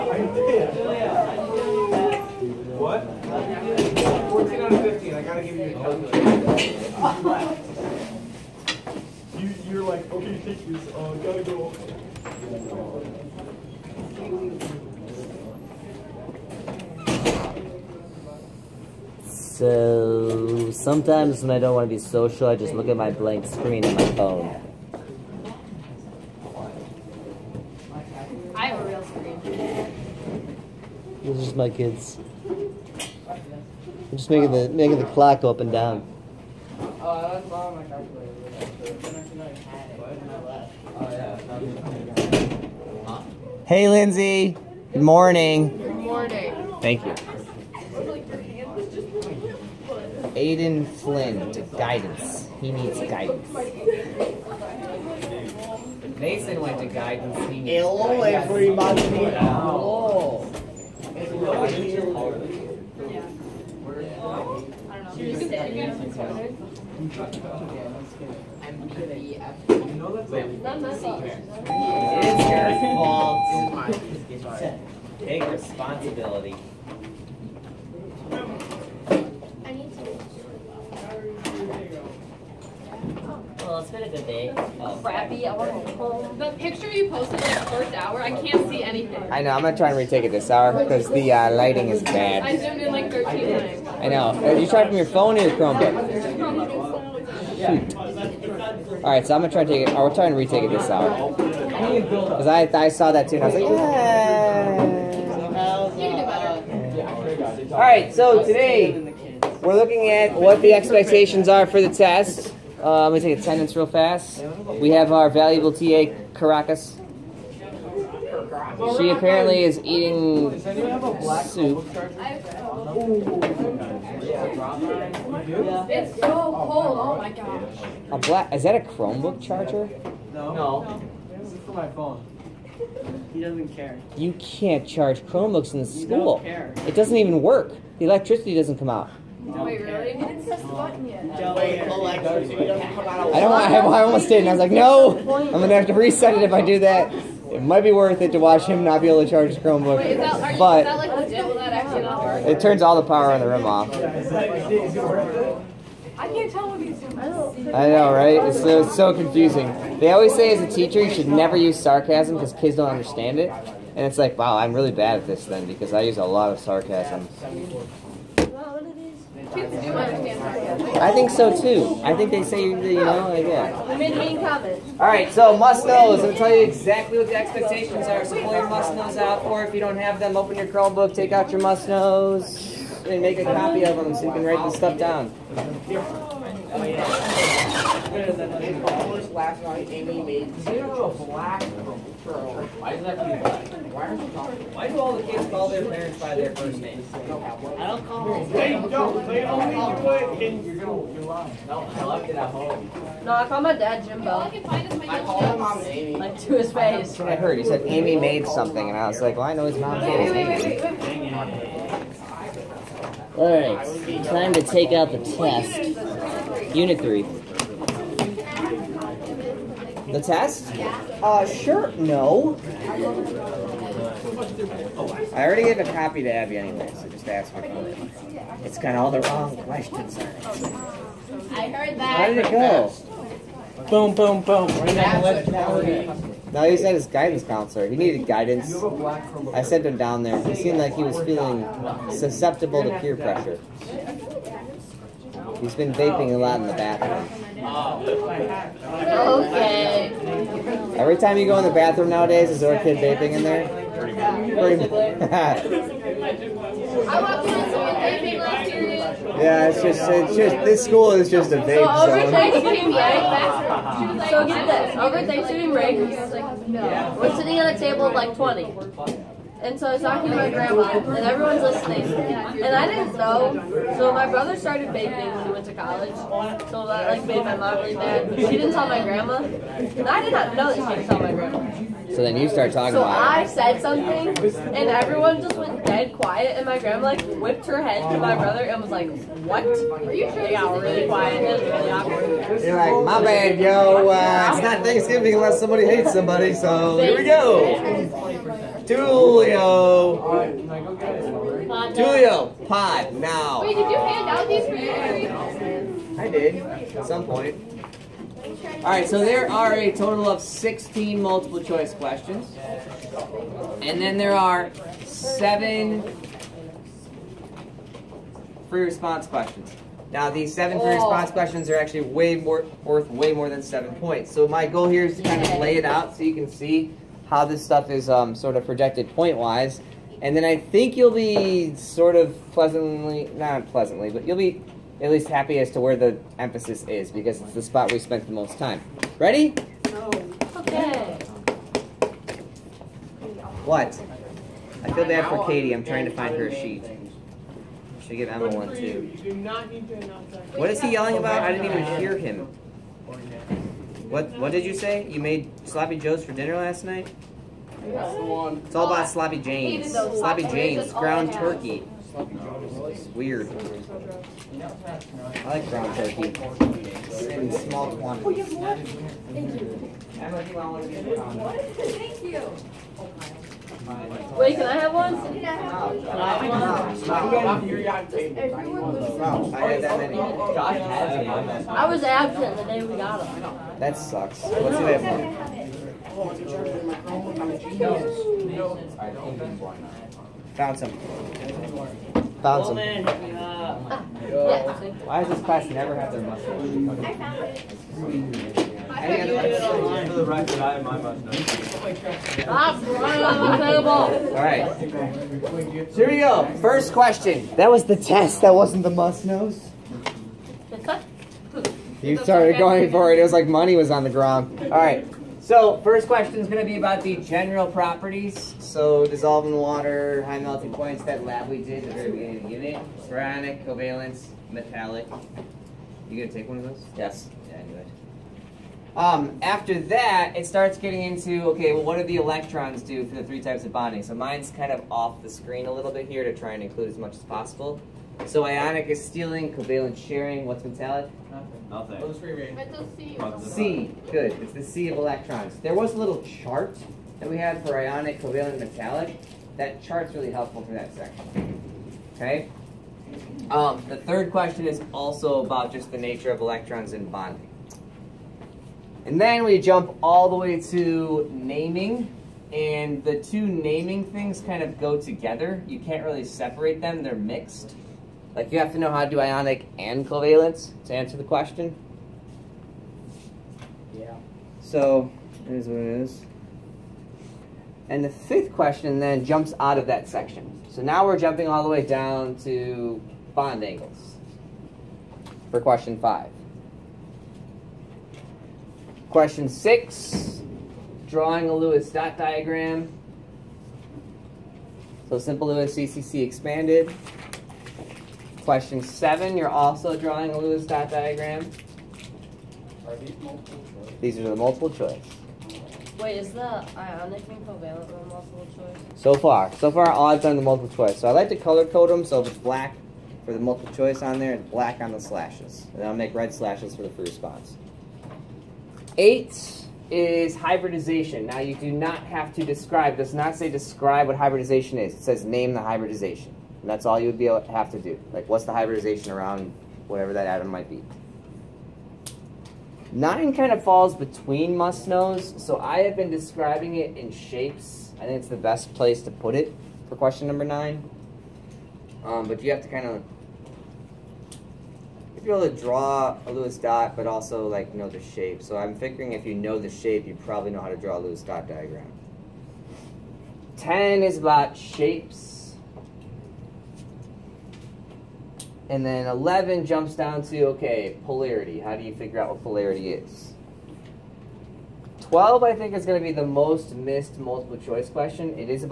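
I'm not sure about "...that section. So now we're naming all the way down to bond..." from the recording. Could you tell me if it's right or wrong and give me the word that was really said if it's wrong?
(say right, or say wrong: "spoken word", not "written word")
wrong: "jumping", not "naming".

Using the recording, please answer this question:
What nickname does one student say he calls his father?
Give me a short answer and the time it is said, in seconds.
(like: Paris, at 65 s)
Jimbo, at 204 s.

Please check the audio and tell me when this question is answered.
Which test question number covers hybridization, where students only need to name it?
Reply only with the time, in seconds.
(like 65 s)
518 s.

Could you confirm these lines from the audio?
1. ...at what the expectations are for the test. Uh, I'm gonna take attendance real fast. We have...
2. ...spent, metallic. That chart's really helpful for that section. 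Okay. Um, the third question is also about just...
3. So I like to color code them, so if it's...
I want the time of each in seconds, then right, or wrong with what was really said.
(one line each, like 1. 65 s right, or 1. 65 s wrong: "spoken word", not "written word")
1. 110 s right
2. 448 s wrong: "covalent", not "spent"
3. 510 s right.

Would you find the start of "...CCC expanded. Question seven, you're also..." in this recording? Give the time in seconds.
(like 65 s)
495 s.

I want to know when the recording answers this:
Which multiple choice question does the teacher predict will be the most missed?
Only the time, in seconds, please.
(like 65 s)
565 s.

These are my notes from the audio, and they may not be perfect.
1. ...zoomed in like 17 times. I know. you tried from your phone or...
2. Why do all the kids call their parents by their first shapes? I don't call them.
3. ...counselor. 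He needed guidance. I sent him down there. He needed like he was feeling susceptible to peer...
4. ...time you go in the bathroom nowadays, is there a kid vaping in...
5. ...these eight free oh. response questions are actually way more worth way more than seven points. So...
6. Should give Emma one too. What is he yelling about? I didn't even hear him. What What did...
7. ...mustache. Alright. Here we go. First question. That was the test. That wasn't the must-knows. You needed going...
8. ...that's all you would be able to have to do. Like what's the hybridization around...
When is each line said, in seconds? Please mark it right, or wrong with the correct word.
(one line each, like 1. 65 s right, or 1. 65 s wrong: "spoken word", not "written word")
1. 92 s wrong: "13", not "17"
2. 194 s wrong: "names", not "shapes"
3. 237 s wrong: "seemed", not "needed"
4. 251 s right
5. 320 s wrong: "seven", not "eight"
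6. 348 s right
7. 400 s wrong: "started", not "needed"
8. 526 s right.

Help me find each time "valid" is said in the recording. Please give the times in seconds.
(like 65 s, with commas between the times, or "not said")
not said.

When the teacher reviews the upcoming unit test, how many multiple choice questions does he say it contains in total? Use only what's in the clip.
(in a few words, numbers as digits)
16.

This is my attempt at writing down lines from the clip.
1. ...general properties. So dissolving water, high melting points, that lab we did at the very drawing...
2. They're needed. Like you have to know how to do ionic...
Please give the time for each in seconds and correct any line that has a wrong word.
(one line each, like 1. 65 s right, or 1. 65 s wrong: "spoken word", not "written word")
1. 417 s wrong: "beginning", not "drawing"
2. 467 s wrong: "mixed", not "needed".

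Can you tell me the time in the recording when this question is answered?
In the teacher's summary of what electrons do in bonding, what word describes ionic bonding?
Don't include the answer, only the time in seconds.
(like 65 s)
439 s.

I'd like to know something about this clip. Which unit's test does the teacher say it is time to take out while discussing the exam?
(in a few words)
Unit 3.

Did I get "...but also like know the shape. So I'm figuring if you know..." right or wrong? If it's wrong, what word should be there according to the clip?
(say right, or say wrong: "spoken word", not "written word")
right.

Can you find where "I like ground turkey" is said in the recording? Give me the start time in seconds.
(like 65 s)
365 s.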